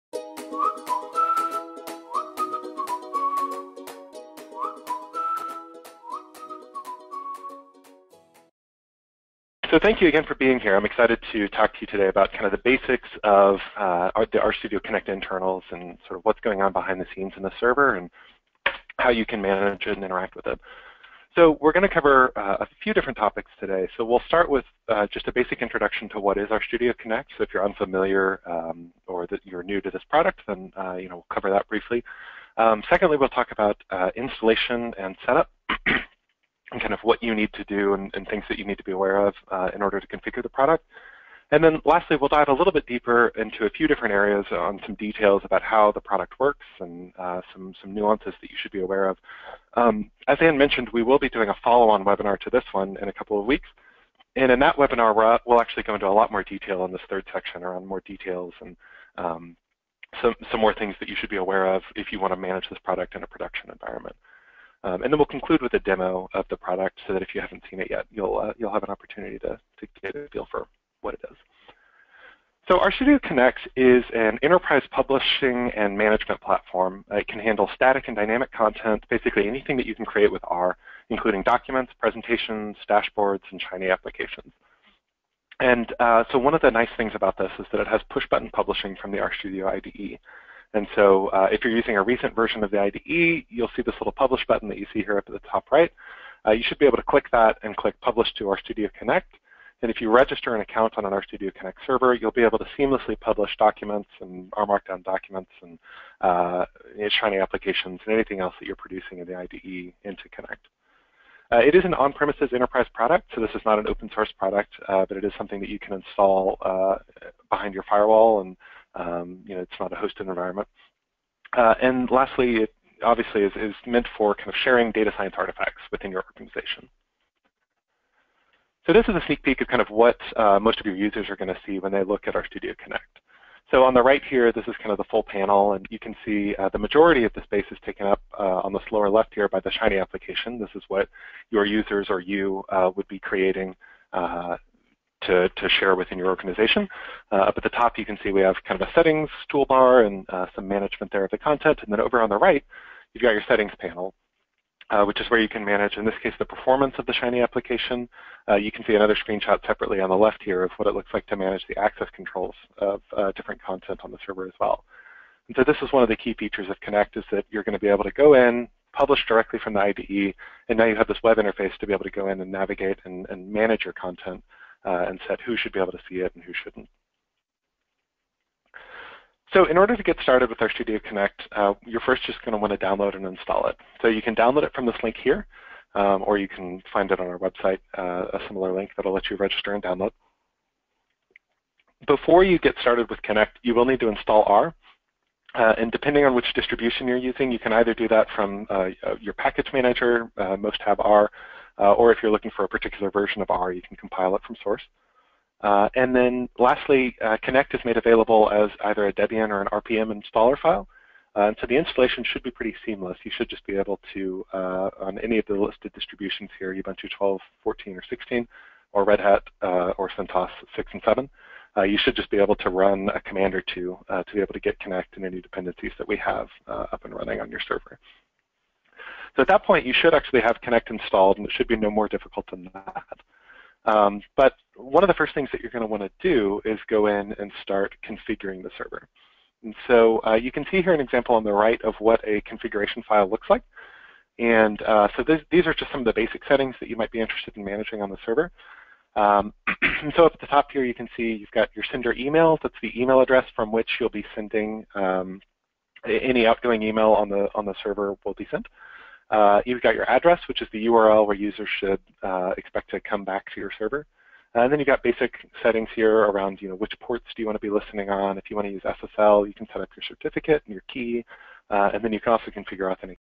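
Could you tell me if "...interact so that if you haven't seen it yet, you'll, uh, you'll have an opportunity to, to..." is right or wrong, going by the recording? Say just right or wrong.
wrong.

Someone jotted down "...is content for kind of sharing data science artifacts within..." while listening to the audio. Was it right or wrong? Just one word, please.
wrong.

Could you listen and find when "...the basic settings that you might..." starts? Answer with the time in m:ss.
4:06.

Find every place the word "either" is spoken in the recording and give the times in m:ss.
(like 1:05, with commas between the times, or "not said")
3:17, 3:28.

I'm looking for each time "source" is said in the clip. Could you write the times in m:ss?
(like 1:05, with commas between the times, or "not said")
1:54, 3:24.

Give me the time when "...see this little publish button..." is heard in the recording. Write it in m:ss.
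1:33.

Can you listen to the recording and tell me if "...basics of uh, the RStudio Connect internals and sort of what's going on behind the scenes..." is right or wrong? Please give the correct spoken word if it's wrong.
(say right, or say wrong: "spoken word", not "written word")
right.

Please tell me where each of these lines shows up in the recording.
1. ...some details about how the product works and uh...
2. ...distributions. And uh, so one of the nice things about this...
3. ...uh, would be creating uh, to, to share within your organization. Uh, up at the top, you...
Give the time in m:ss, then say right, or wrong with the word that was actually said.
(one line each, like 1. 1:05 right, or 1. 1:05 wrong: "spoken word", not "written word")
1. 0:44 right
2. 1:23 wrong: "applications", not "distributions"
3. 2:22 right.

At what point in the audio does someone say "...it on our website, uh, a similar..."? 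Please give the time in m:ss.
3:07.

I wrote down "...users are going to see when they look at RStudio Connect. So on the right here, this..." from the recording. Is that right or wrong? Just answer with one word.
right.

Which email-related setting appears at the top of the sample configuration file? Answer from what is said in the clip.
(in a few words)
sender email.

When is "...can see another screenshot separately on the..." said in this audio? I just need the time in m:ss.
2:38.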